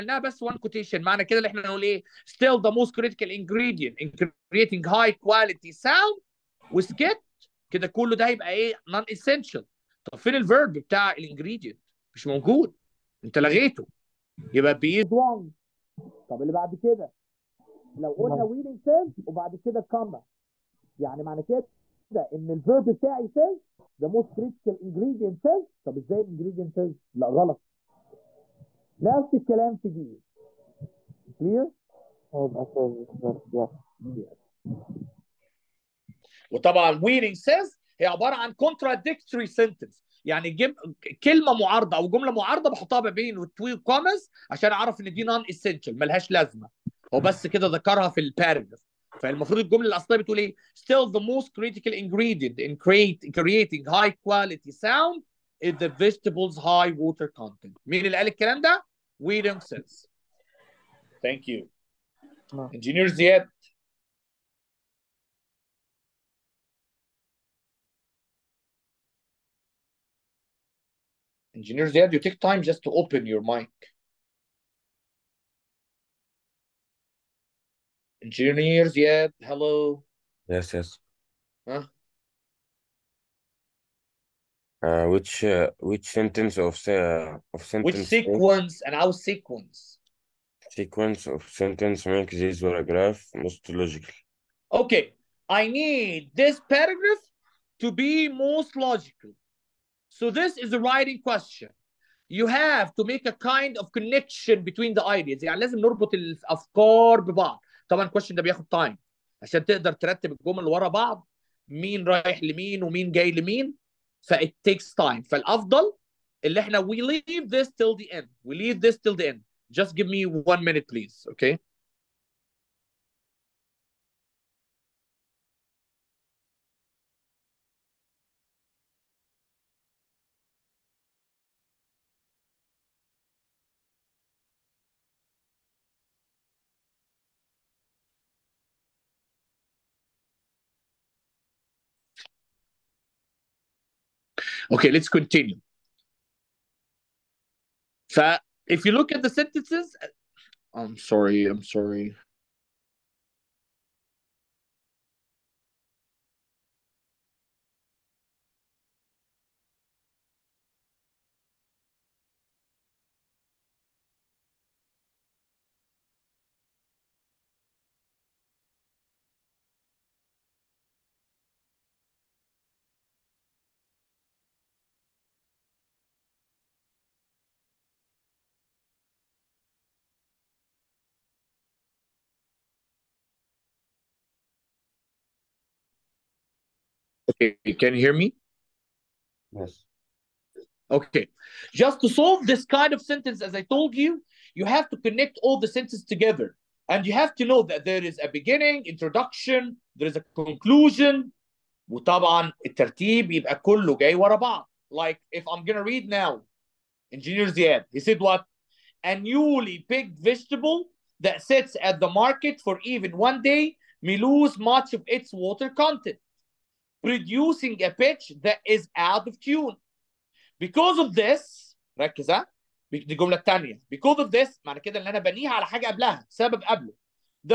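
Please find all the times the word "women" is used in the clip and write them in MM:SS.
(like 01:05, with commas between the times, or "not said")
not said.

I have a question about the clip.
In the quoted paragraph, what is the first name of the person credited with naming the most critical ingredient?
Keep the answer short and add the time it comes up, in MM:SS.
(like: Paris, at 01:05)
William, at 00:59.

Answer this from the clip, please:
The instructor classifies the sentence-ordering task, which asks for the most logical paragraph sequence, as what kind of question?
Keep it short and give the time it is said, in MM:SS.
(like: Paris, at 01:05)
writing question, at 01:40.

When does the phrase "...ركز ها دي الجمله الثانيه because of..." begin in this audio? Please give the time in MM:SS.
03:41.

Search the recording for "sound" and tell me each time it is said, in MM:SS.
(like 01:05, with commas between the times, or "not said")
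00:05, 00:54.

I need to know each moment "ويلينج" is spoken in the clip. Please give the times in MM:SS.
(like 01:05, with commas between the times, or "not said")
00:18, 00:37.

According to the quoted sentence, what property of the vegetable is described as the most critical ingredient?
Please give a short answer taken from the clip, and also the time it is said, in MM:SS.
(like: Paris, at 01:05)
high water content, at 00:56.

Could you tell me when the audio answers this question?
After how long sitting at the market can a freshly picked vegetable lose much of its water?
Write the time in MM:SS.
03:33.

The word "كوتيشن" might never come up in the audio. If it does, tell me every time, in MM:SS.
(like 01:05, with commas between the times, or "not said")
00:00.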